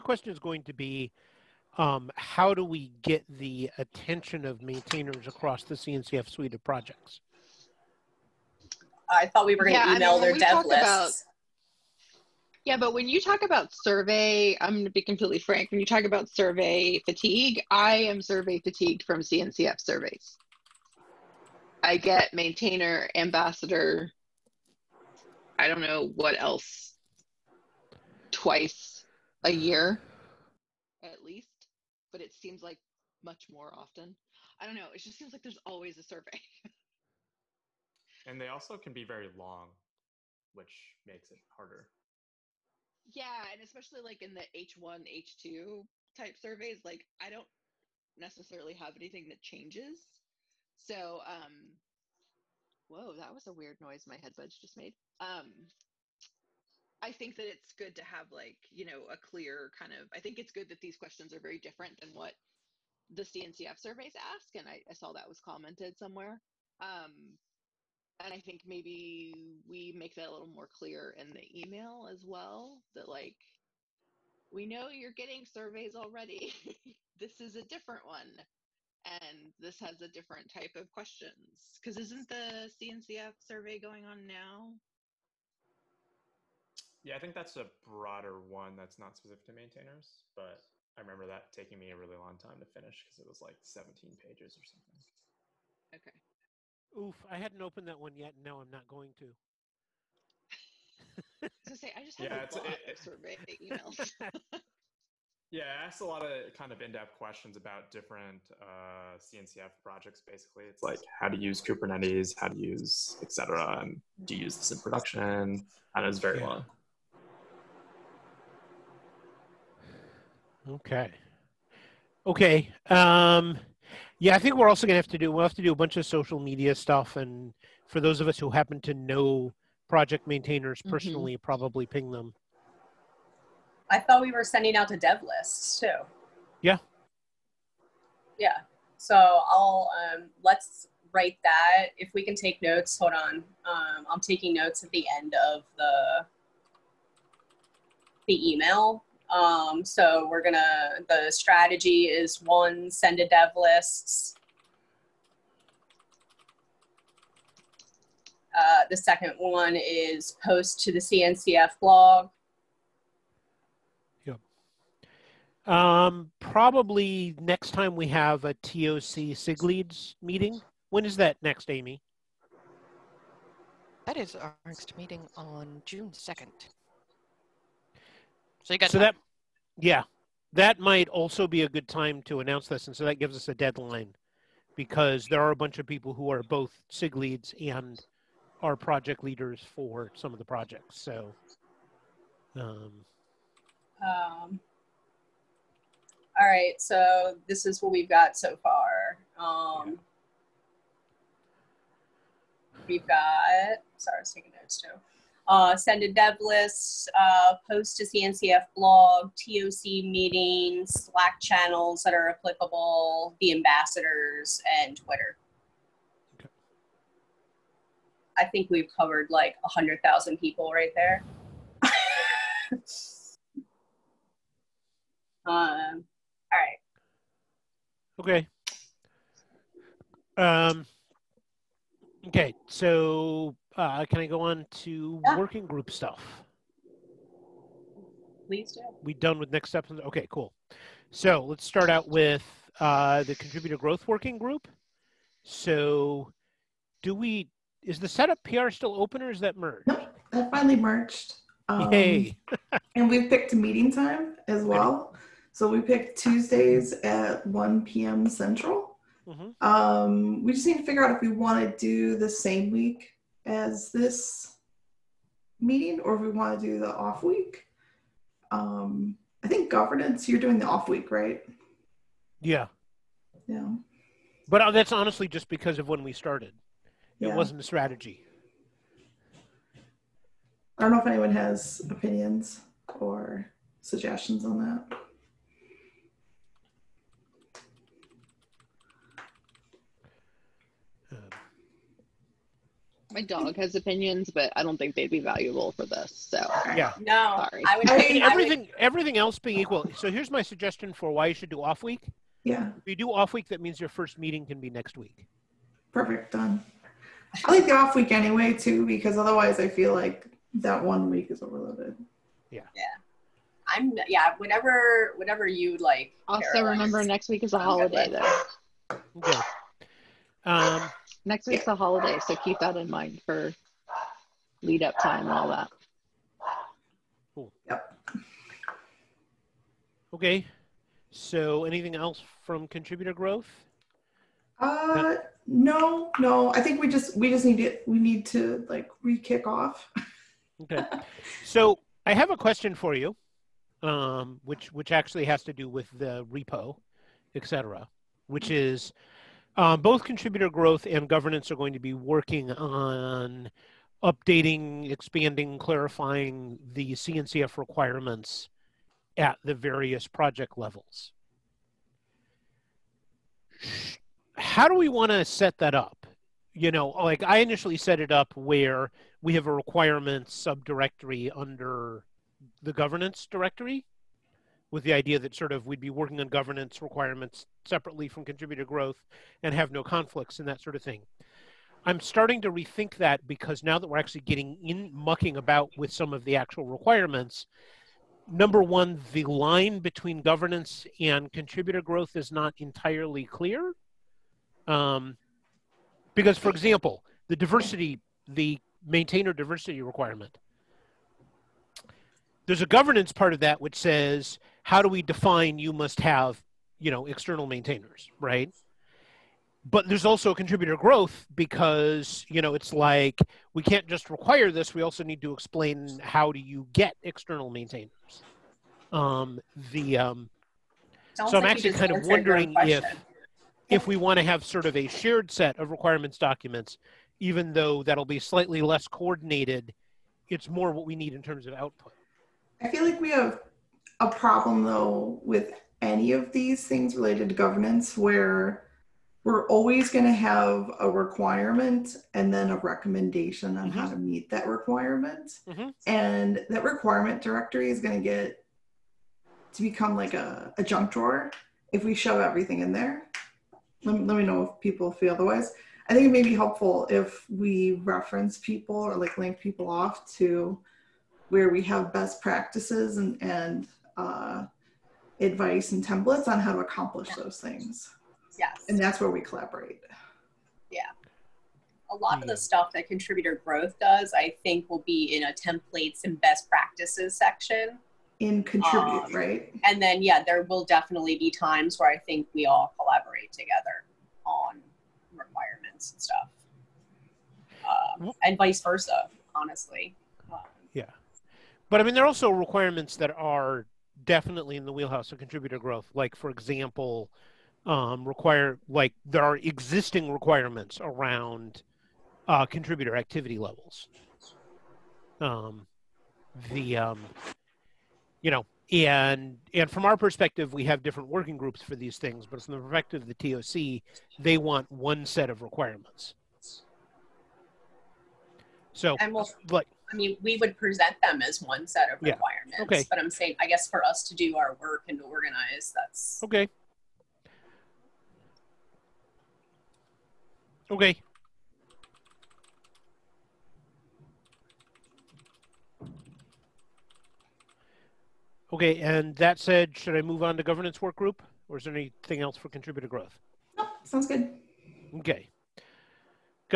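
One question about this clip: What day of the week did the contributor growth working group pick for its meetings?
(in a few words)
Tuesdays.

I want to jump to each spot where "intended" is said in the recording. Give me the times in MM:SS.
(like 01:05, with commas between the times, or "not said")
not said.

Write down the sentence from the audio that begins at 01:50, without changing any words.
Basically, it's like how to use Kubernetes, how to use etcd.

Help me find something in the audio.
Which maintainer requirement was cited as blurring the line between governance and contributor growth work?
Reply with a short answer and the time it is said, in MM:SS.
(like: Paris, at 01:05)
maintainer diversity, at 06:38.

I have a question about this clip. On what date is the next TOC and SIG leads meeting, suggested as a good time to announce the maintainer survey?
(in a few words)
June 2nd.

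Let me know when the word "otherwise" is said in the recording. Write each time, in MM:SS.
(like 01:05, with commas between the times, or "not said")
05:09, 07:35.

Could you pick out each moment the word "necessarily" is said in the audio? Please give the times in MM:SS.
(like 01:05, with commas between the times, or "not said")
00:48.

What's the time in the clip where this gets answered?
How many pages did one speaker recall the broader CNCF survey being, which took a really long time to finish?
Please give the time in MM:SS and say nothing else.
01:33.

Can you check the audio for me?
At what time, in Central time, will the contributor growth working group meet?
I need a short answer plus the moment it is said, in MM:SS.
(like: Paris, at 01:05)
1 p.m., at 04:17.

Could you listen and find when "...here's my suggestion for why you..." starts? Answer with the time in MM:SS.
05:00.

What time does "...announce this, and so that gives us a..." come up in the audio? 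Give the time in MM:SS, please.
03:02.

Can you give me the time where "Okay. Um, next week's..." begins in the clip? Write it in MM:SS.
05:19.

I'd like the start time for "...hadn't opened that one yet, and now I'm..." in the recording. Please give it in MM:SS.
01:37.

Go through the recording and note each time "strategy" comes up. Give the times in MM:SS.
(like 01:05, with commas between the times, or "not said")
02:31, 04:37.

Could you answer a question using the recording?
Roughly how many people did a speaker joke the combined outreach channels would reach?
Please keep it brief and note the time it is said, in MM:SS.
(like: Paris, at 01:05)
100,000, at 03:39.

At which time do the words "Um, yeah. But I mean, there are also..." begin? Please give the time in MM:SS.
08:10.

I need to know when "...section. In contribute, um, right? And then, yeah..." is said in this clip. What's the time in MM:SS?
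07:57.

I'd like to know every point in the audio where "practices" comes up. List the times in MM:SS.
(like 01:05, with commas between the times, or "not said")
07:42, 07:56.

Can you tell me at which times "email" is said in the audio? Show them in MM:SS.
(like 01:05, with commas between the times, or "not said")
00:09, 01:11, 01:43, 02:28.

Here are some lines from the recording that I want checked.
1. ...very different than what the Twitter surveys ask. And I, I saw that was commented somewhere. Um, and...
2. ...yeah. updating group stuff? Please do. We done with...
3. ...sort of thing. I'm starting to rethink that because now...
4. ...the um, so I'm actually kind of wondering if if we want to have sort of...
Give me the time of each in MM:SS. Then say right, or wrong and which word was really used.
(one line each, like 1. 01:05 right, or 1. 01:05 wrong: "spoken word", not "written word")
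1. 01:01 wrong: "CNCF", not "Twitter"
2. 03:55 wrong: "working", not "updating"
3. 06:20 right
4. 06:59 right.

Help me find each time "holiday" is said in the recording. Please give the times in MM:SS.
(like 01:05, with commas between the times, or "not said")
05:17, 05:21.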